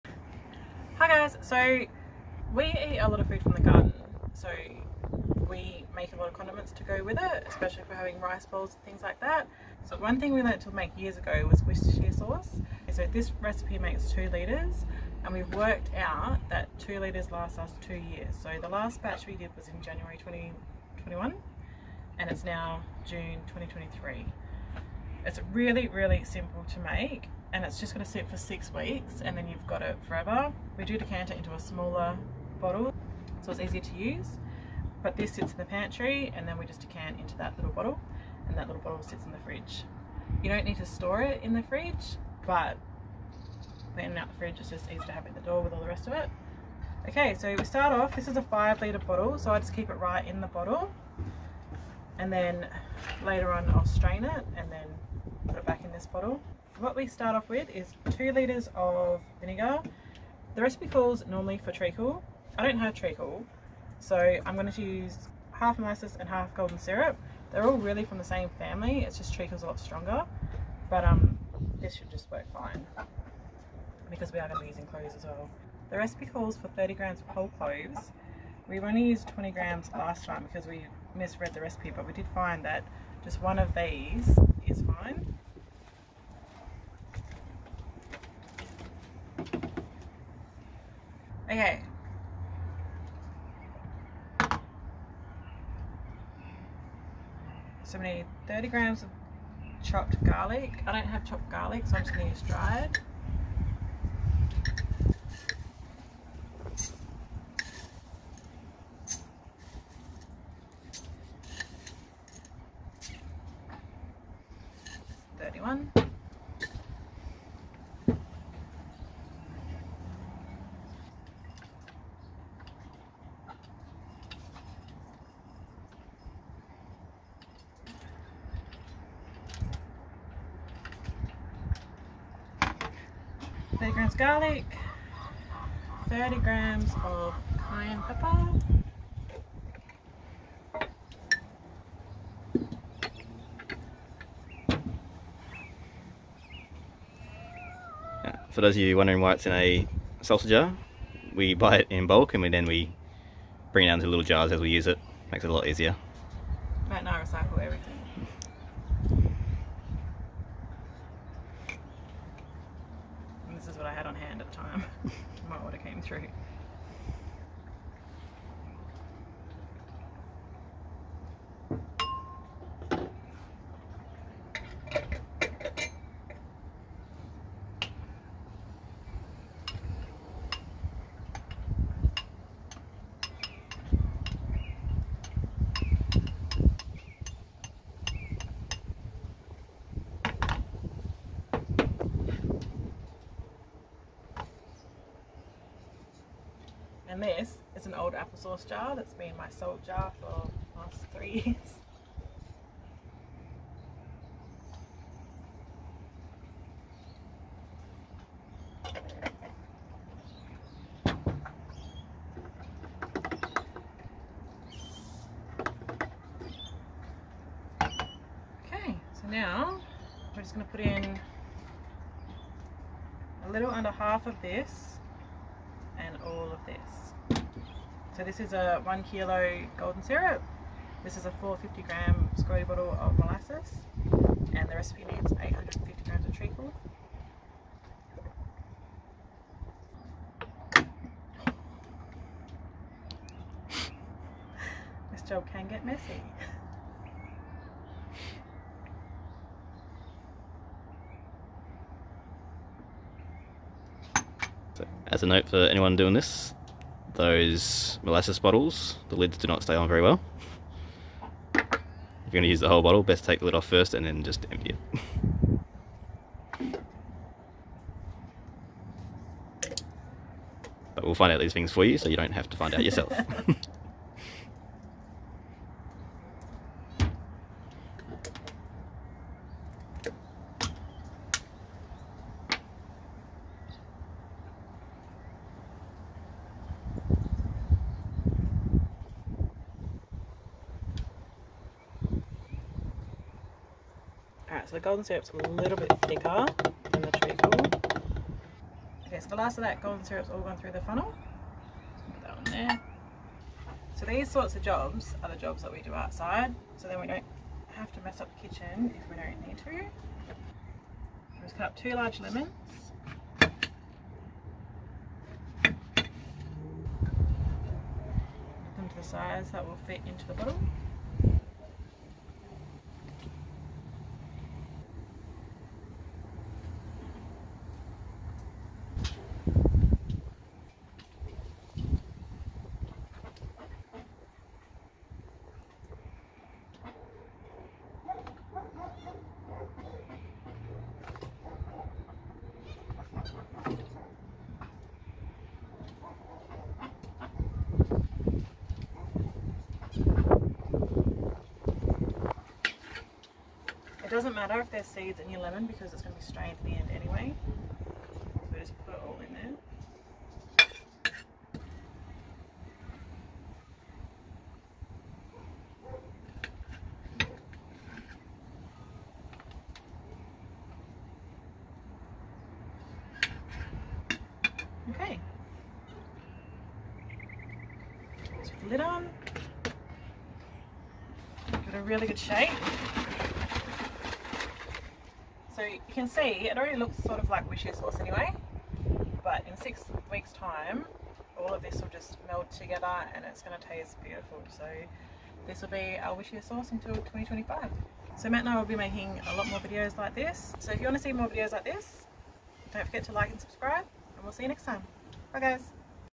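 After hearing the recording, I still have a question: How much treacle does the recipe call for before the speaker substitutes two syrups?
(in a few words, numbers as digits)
850 grams.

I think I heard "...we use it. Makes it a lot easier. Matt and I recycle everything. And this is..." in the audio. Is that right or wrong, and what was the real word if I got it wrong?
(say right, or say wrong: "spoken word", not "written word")
right.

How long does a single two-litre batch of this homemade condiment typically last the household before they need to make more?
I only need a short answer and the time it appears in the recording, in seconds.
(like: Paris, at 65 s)
2 years, at 17 s.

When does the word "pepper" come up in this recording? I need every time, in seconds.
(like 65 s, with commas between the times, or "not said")
138 s.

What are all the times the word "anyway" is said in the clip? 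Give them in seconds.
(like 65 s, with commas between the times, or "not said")
356 s, 387 s.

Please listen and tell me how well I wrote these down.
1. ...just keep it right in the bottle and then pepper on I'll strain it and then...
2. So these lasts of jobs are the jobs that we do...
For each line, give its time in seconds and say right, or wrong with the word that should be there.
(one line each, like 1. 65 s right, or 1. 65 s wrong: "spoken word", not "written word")
1. 49 s wrong: "later", not "pepper"
2. 303 s wrong: "sorts", not "lasts".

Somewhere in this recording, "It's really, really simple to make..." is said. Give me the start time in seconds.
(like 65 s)
25 s.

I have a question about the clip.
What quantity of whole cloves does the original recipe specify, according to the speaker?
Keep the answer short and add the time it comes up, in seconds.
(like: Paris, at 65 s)
30 grams, at 76 s.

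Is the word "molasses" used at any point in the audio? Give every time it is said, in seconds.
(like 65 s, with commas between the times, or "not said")
65 s, 233 s, 258 s.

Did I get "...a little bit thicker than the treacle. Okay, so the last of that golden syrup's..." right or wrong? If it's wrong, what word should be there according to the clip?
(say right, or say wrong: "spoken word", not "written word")
right.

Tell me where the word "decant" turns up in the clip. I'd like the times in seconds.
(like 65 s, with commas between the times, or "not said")
30 s, 36 s.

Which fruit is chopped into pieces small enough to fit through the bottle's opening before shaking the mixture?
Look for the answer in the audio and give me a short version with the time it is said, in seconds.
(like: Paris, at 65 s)
lemons, at 312 s.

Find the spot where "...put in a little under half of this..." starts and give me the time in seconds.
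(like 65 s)
220 s.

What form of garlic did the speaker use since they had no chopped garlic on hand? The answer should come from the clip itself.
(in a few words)
dried.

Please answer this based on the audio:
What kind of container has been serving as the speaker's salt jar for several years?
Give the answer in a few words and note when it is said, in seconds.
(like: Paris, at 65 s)
applesauce jar, at 198 s.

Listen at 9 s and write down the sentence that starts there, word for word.
So one thing we learnt to make years ago was Worcestershire sauce.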